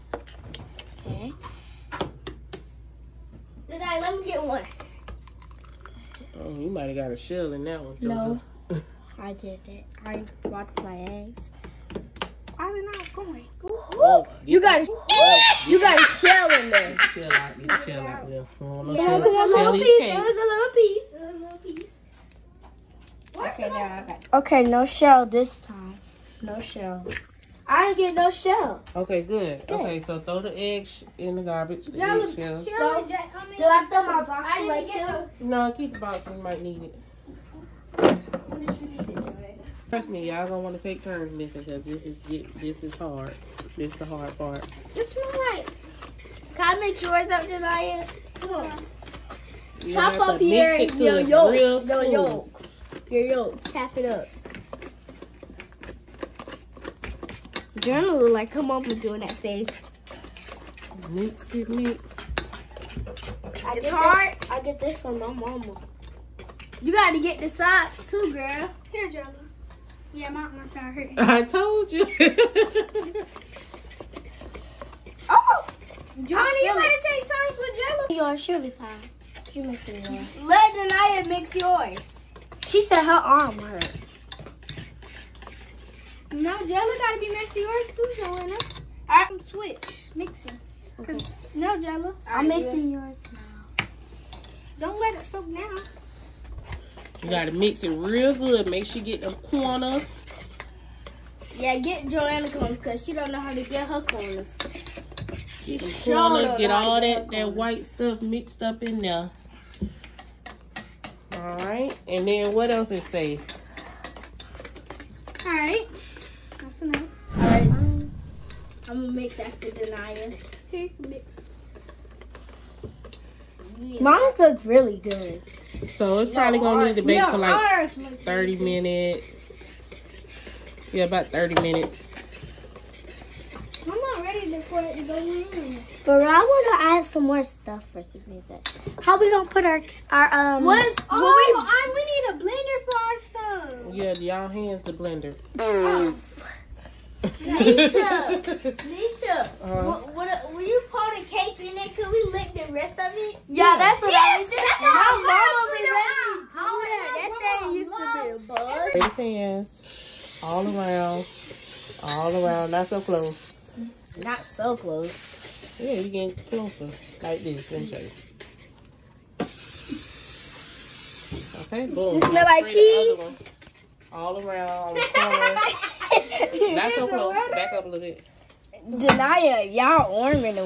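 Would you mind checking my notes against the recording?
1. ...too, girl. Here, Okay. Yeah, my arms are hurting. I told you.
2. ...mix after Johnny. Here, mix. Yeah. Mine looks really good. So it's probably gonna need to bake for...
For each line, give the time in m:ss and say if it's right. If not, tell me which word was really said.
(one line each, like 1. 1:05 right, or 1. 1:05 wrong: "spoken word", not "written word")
1. 1:08 wrong: "Journal", not "Okay"
2. 1:59 wrong: "Denia", not "Johnny".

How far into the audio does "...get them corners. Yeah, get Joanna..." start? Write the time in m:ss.
1:39.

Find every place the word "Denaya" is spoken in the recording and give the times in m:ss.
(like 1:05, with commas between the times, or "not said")
1:20.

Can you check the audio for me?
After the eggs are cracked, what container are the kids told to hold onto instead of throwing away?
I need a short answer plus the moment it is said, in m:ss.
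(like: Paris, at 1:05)
the box, at 0:35.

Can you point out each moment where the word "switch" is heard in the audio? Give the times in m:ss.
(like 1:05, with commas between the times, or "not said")
1:29.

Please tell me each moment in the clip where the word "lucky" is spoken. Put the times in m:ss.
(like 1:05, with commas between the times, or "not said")
not said.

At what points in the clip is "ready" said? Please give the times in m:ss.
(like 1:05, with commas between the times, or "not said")
2:14.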